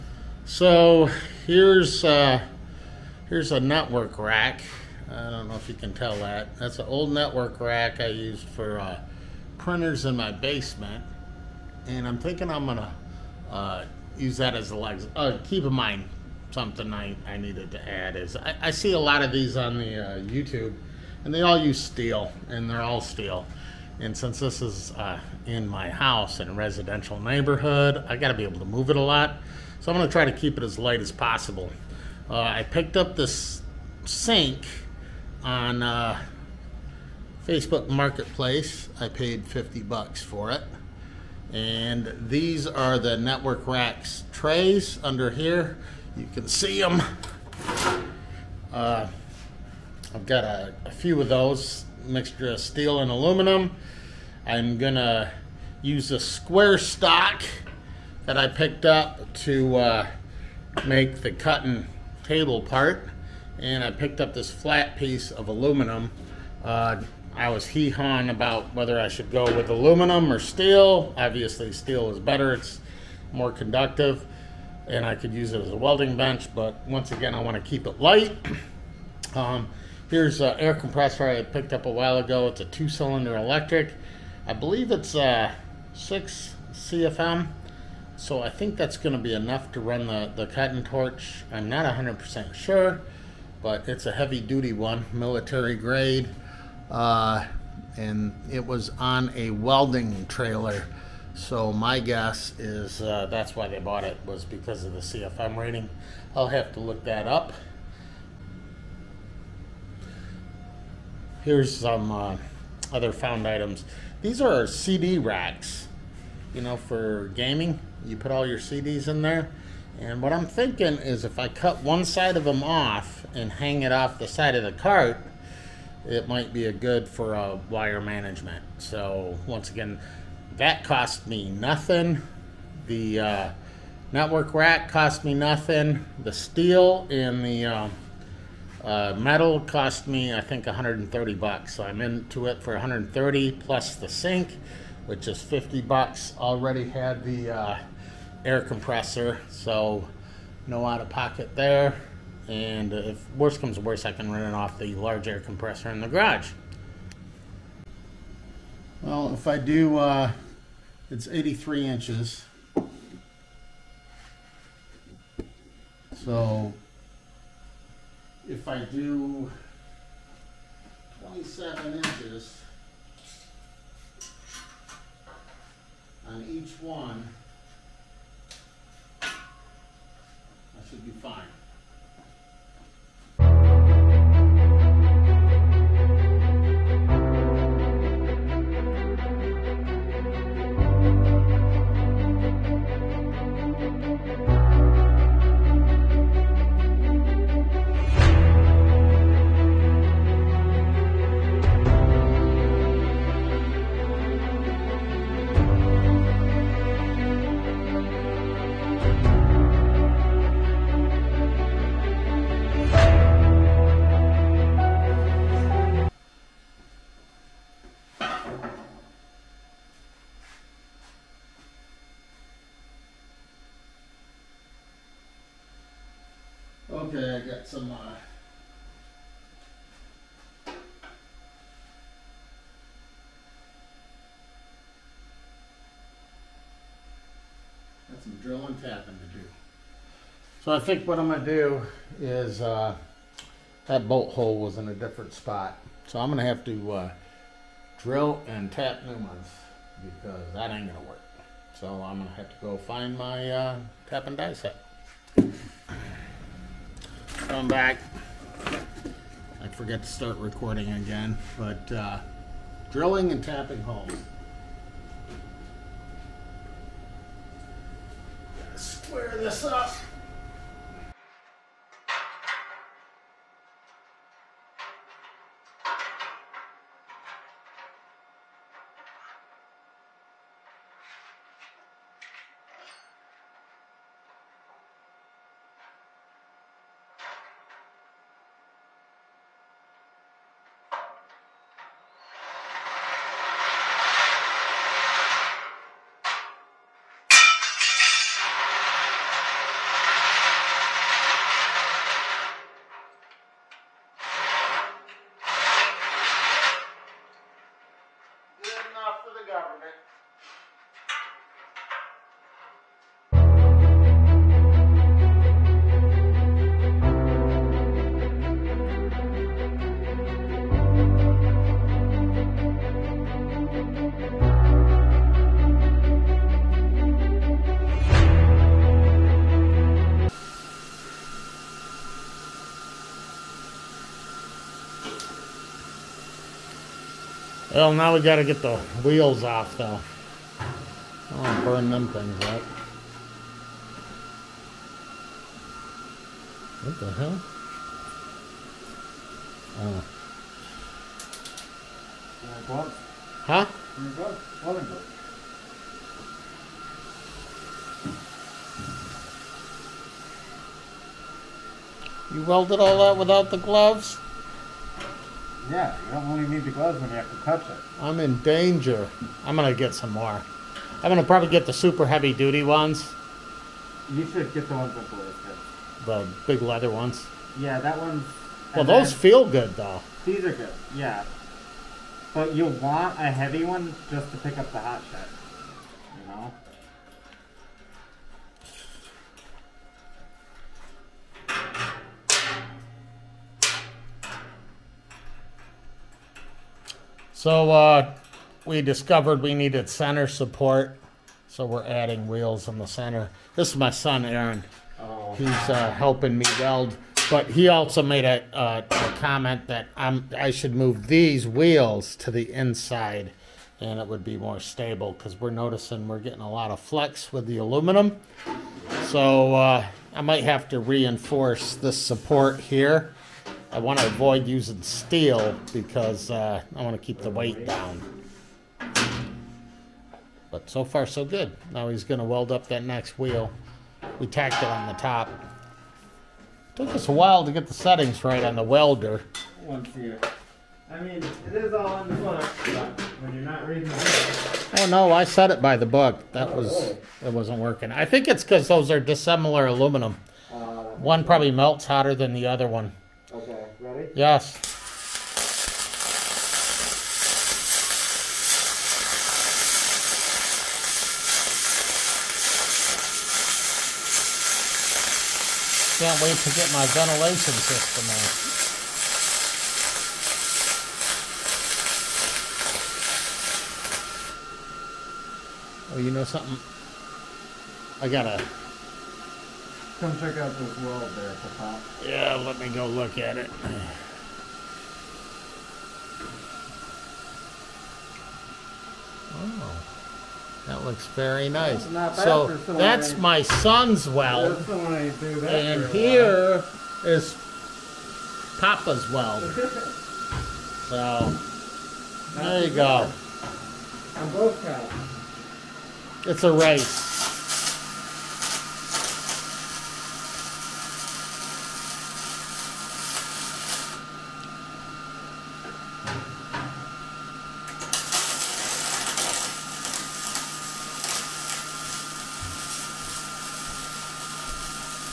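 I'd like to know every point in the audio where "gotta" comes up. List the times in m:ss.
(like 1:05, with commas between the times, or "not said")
0:28, 5:38.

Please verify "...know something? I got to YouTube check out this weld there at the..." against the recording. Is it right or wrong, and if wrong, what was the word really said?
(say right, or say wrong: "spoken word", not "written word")
wrong: "Come", not "YouTube".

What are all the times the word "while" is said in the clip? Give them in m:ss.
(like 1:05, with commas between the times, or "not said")
1:21, 7:17.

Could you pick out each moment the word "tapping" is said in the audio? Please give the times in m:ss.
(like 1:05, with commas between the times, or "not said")
3:58, 4:23.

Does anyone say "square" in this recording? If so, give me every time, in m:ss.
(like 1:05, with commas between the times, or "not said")
0:56, 4:28.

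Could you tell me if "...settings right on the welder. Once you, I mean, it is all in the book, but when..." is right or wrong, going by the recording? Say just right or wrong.
right.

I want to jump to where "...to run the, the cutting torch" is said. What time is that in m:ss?
1:29.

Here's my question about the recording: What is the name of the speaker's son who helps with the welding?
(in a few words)
Aaron.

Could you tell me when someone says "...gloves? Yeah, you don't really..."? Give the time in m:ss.
6:03.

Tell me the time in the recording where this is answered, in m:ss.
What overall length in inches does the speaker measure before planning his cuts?
2:41.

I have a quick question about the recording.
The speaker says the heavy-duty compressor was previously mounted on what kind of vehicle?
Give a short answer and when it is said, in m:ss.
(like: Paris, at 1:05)
a welding trailer, at 1:39.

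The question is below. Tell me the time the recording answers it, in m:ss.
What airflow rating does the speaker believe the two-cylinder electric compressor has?
1:25.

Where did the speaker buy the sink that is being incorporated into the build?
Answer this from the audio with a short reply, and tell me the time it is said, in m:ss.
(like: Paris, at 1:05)
Facebook Marketplace, at 0:37.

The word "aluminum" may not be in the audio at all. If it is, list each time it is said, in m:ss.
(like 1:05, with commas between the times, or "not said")
0:53, 1:05, 1:09, 6:57, 7:29.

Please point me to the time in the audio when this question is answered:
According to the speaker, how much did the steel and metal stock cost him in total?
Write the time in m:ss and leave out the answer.
2:20.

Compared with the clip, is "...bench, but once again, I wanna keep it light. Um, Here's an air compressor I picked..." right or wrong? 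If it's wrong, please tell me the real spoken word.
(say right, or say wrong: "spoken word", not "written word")
right.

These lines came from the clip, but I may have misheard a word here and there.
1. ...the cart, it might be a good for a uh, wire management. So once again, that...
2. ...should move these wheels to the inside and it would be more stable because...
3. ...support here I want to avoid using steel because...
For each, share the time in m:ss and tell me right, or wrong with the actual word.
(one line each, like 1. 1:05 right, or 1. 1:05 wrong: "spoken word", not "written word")
1. 2:04 right
2. 6:50 right
3. 7:02 right.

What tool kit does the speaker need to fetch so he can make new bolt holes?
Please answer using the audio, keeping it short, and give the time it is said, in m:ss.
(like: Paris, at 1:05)
tap and die set, at 4:14.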